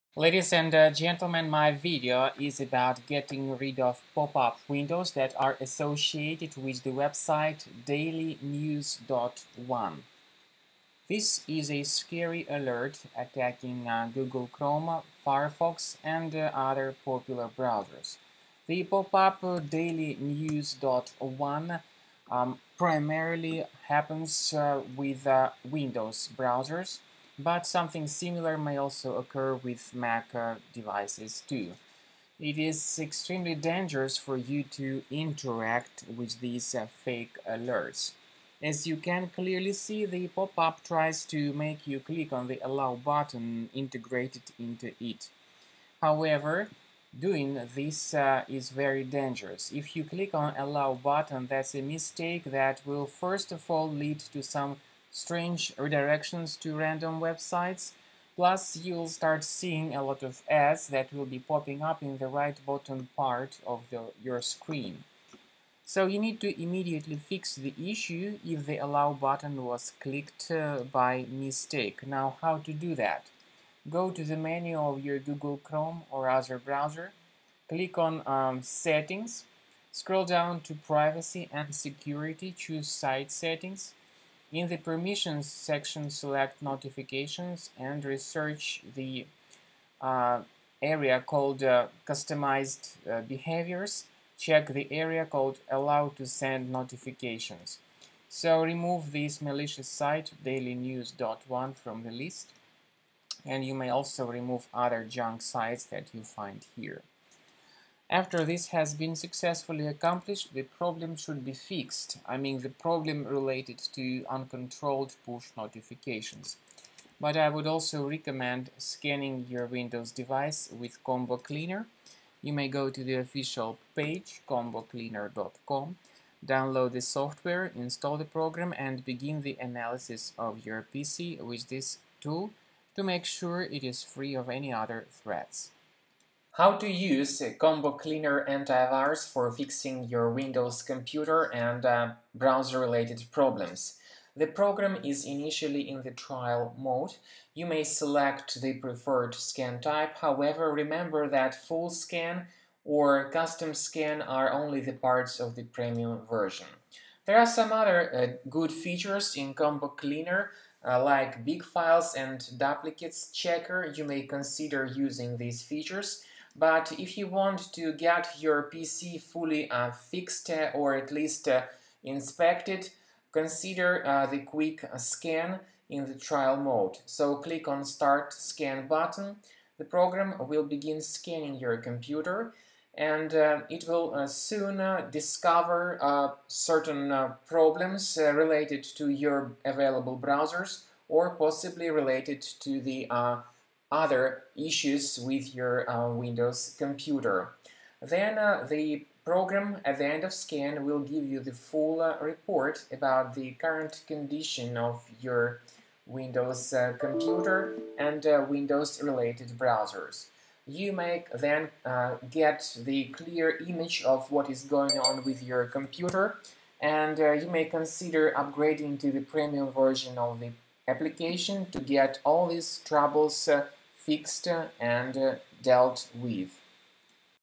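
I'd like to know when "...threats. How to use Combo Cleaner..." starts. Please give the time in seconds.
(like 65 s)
135 s.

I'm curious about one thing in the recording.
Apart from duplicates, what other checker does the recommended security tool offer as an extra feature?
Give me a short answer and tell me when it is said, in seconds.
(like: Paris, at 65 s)
big files, at 161 s.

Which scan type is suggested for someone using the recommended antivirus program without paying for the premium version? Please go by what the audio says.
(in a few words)
quick scan.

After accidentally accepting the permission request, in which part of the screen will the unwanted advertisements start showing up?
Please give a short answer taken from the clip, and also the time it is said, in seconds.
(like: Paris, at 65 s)
right bottom, at 62 s.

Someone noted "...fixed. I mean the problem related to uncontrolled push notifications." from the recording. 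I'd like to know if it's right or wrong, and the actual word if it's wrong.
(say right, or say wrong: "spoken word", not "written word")
right.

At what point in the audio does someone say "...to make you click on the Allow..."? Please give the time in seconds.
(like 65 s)
41 s.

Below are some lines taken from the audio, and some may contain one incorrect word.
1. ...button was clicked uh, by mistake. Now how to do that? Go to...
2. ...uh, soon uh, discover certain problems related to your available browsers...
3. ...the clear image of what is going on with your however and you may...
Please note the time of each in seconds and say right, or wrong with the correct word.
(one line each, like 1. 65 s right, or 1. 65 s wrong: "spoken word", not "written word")
1. 69 s right
2. 184 s right
3. 212 s wrong: "computer", not "however".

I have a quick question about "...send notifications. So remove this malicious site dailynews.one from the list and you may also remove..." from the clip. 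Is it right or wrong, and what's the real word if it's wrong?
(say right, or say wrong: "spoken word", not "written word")
right.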